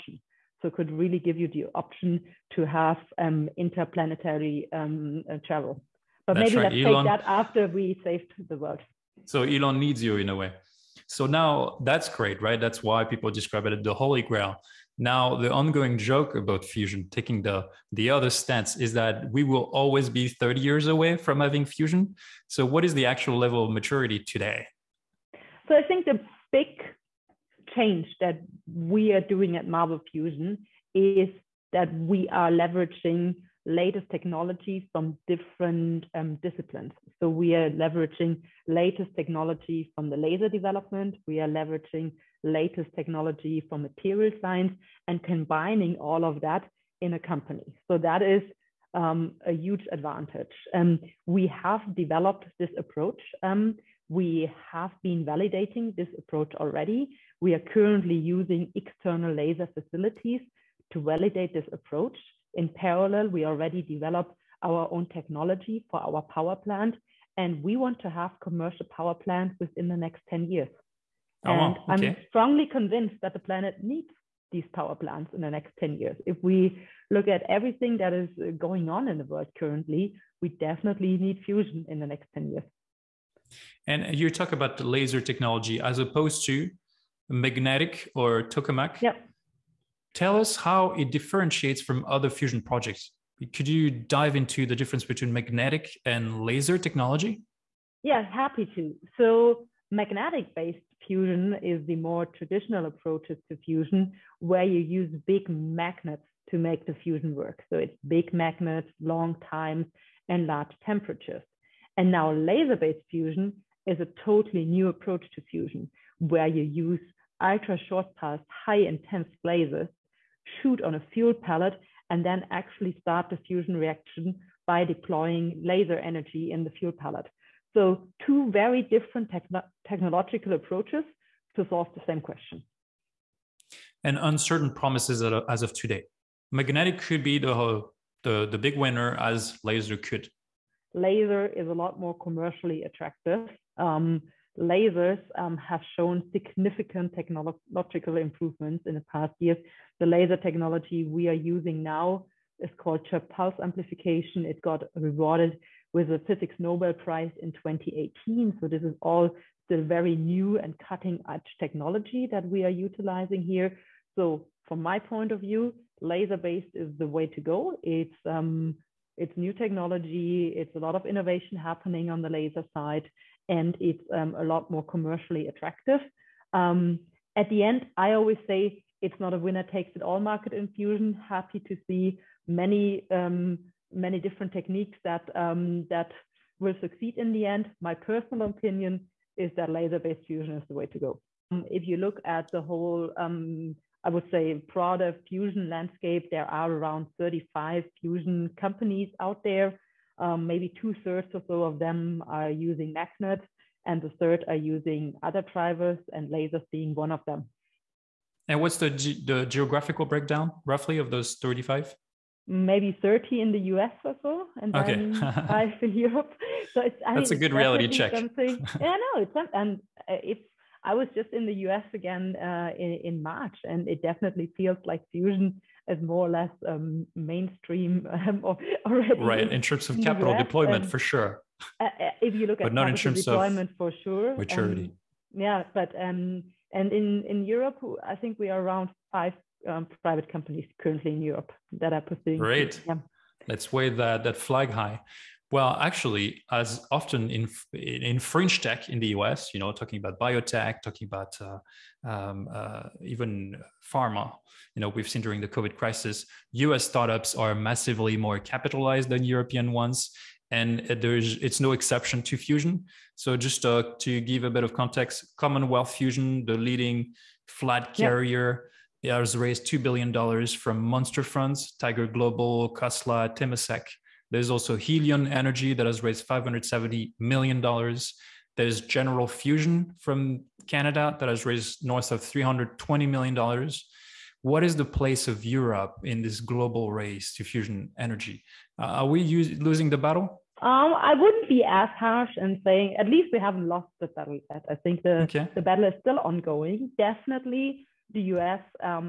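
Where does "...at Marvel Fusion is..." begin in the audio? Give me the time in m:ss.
0:29.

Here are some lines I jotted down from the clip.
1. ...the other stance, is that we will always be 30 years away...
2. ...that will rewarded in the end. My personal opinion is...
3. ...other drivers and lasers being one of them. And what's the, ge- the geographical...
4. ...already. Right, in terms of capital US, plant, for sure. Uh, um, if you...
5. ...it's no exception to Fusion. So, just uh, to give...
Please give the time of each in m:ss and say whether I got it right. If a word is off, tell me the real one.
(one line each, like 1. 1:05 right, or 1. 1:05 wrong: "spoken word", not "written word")
1. 0:17 right
2. 3:05 wrong: "succeed", not "rewarded"
3. 3:25 right
4. 3:48 wrong: "deployment", not "plant"
5. 4:21 right.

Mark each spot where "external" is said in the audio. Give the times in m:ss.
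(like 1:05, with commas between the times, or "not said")
0:58.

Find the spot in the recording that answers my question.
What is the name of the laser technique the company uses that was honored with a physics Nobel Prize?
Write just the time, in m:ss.
2:33.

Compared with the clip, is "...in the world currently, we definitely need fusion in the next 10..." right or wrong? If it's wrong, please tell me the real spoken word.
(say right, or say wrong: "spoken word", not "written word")
right.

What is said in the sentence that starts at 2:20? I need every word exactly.
Laser is a lot more commercially attractive.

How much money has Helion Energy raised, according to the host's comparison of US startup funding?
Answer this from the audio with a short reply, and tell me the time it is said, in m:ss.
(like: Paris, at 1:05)
$570 million, at 4:36.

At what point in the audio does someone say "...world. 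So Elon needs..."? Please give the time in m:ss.
0:08.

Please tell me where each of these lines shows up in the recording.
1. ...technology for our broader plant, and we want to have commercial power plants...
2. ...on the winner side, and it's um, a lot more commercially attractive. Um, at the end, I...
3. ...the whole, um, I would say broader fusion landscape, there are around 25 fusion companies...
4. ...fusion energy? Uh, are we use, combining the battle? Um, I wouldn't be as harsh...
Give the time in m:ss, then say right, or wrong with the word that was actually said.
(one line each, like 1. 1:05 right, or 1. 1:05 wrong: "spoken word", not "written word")
1. 1:05 wrong: "power", not "broader"
2. 2:52 wrong: "laser", not "winner"
3. 3:12 wrong: "35", not "25"
4. 4:47 wrong: "losing", not "combining".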